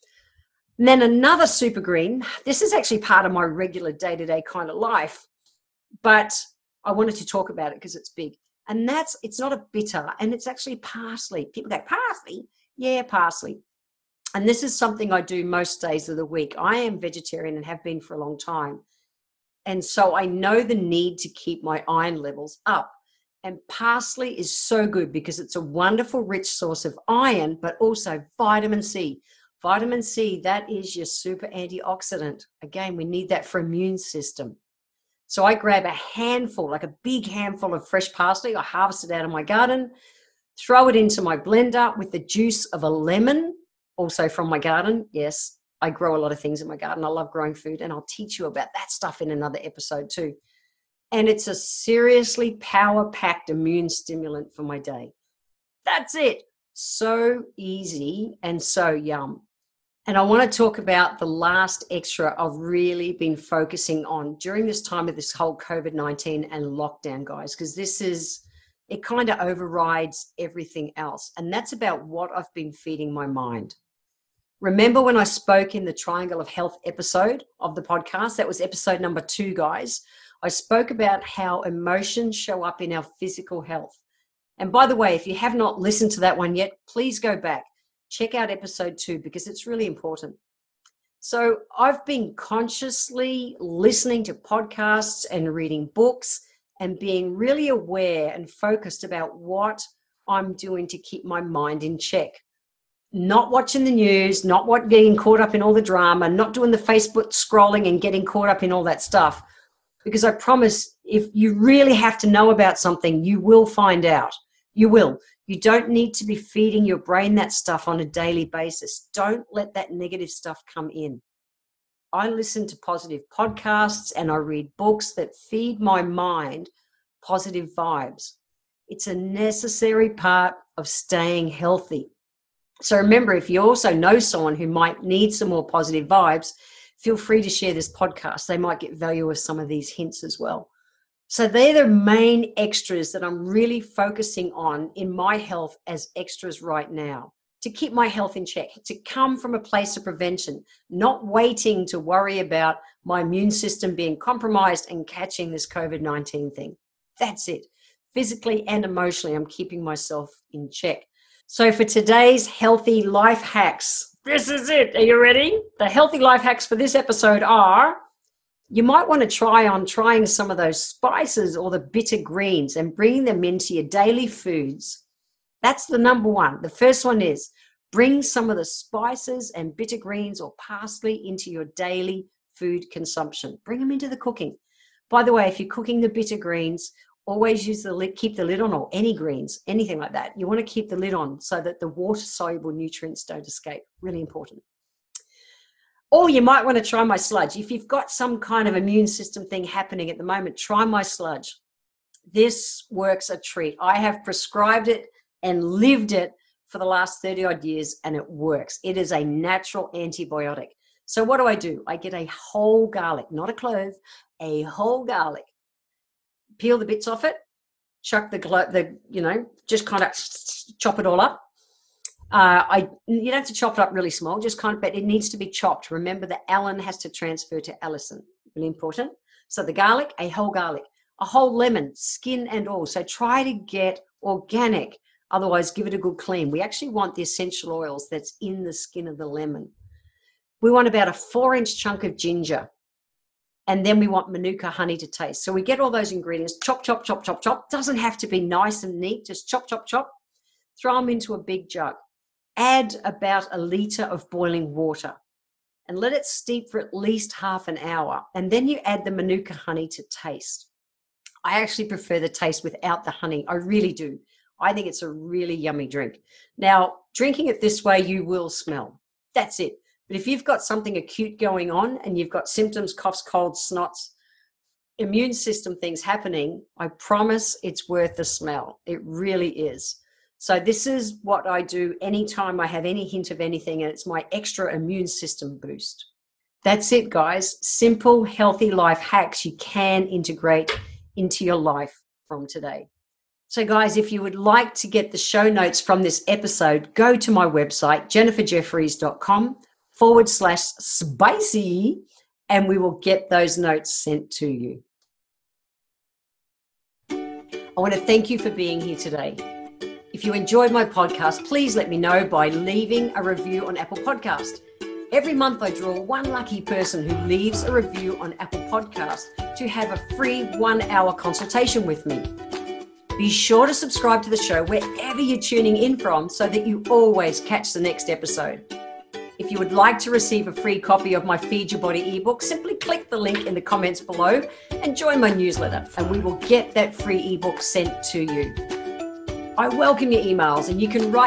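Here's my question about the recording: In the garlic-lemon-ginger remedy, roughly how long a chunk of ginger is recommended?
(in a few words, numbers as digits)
4 inch.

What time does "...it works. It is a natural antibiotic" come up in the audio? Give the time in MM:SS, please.
03:28.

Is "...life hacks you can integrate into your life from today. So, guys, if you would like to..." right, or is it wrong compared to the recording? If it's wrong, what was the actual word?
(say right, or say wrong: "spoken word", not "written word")
right.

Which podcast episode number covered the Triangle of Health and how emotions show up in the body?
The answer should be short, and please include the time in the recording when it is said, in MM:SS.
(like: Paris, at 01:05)
2, at 01:18.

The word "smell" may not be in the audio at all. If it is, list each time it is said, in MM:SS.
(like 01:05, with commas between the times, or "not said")
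04:28, 04:38.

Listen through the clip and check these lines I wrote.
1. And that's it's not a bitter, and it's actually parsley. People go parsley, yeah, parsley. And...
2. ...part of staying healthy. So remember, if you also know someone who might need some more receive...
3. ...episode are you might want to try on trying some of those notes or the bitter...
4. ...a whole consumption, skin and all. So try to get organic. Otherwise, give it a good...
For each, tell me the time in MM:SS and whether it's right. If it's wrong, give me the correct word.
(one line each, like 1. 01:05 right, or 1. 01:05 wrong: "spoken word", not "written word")
1. 00:08 right
2. 02:10 wrong: "positive", not "receive"
3. 02:46 wrong: "spices", not "notes"
4. 03:51 wrong: "lemon", not "consumption".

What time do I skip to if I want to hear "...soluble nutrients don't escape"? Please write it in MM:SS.
03:12.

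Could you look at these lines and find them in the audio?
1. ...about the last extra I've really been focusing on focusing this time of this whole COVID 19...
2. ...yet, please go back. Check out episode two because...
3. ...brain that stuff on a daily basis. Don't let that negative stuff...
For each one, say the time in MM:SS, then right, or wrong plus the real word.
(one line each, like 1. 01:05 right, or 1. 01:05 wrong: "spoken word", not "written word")
1. 01:00 wrong: "during", not "focusing"
2. 01:26 right
3. 01:56 right.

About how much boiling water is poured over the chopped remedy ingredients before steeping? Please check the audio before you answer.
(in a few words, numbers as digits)
1 litre.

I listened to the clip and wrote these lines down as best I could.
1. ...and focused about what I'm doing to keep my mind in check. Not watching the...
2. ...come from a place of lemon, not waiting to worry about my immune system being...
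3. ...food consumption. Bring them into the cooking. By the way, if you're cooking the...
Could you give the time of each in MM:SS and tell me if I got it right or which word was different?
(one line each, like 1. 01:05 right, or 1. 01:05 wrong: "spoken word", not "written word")
1. 01:38 right
2. 02:29 wrong: "prevention", not "lemon"
3. 03:02 right.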